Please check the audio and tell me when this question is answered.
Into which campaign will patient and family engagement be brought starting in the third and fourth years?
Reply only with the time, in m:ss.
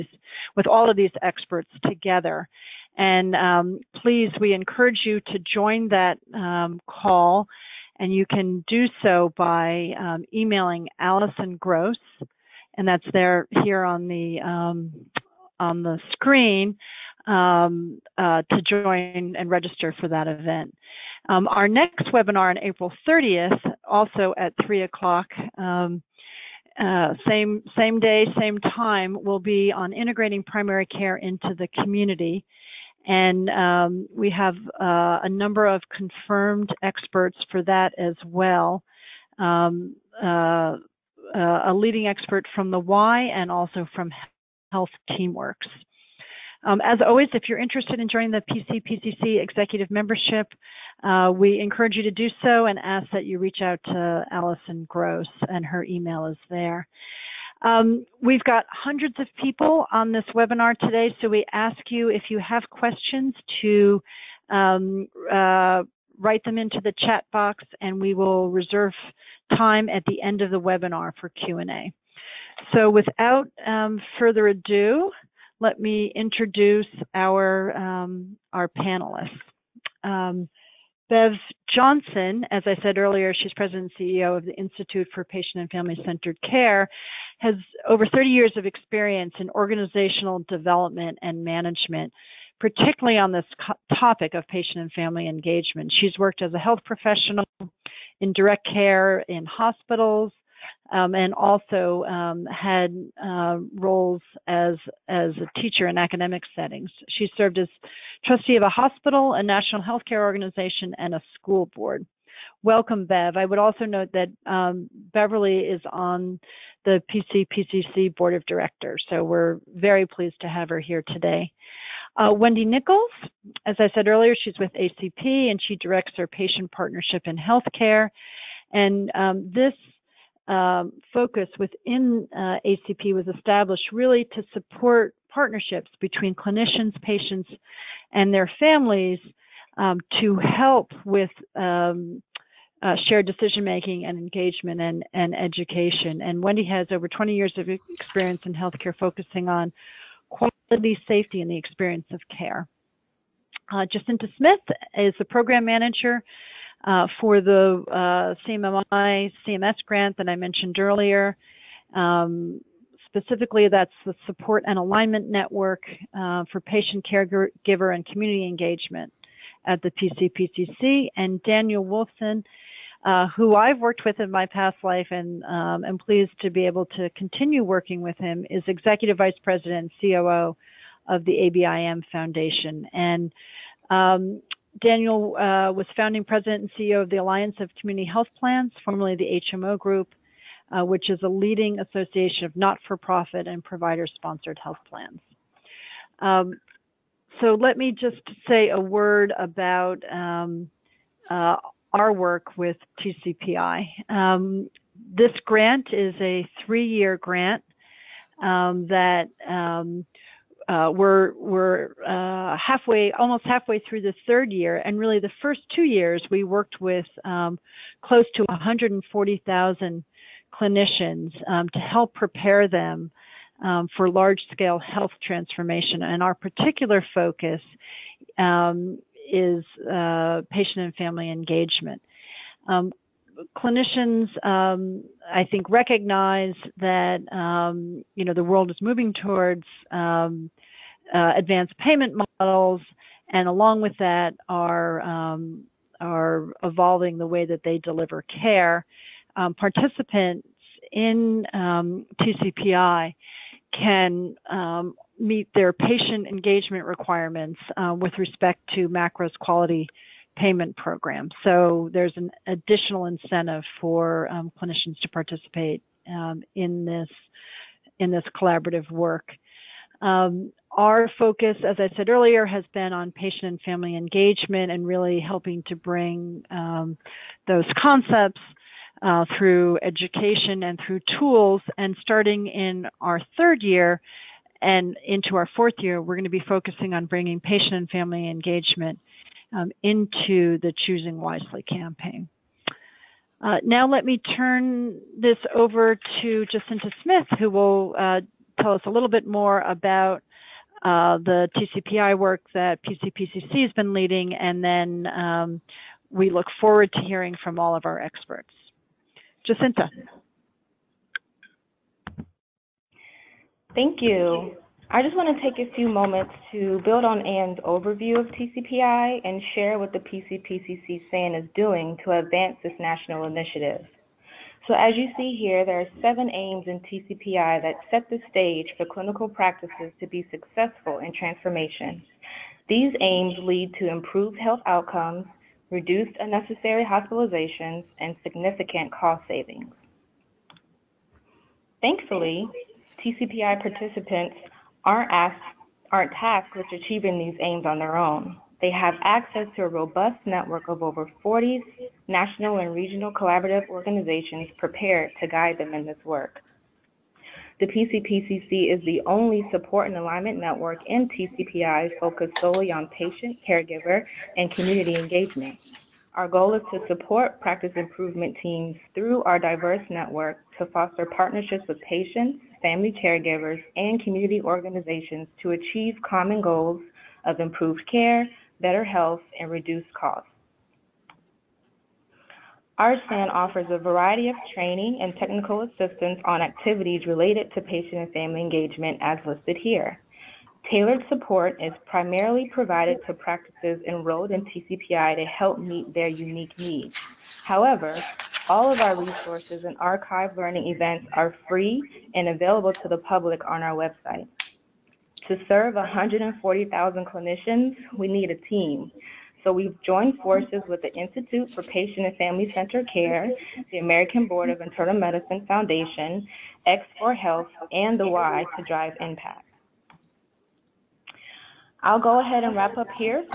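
4:50.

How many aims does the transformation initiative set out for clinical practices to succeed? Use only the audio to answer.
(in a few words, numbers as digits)
7.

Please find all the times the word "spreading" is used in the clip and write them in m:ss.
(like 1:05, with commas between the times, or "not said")
not said.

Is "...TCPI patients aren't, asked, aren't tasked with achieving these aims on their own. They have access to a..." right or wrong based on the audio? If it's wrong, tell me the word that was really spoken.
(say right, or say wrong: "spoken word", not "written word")
wrong: "participants", not "patients".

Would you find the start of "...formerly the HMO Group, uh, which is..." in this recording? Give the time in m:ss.
3:08.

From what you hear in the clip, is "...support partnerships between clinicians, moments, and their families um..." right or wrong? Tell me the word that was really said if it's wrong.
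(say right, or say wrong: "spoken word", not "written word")
wrong: "patients", not "moments".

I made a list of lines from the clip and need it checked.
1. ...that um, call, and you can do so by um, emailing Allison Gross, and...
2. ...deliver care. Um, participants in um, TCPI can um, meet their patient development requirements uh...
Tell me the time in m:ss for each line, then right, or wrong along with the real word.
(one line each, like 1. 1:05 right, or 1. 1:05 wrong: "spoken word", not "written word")
1. 0:05 right
2. 4:07 wrong: "engagement", not "development".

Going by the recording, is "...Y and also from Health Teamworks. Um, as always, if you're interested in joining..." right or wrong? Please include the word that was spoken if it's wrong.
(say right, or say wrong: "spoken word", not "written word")
right.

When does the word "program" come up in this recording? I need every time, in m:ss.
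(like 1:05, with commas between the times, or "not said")
2:35, 4:20.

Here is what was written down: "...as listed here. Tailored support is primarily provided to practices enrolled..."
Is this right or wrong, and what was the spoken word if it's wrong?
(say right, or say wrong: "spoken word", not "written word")
right.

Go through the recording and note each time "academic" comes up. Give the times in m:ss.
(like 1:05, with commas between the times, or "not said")
1:45.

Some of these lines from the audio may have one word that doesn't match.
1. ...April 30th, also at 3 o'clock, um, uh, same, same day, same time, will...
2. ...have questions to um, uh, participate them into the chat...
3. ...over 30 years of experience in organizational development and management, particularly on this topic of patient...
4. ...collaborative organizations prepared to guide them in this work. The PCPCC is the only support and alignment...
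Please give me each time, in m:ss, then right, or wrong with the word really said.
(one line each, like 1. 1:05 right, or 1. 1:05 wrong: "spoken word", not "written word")
1. 0:22 right
2. 1:02 wrong: "write", not "participate"
3. 1:27 right
4. 5:53 right.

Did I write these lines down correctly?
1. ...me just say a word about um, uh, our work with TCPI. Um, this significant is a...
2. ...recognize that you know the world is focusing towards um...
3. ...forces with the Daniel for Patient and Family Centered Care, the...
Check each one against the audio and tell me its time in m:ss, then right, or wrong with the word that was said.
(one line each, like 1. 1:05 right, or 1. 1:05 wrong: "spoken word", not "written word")
1. 3:17 wrong: "grant", not "significant"
2. 3:55 wrong: "moving", not "focusing"
3. 6:50 wrong: "Institute", not "Daniel".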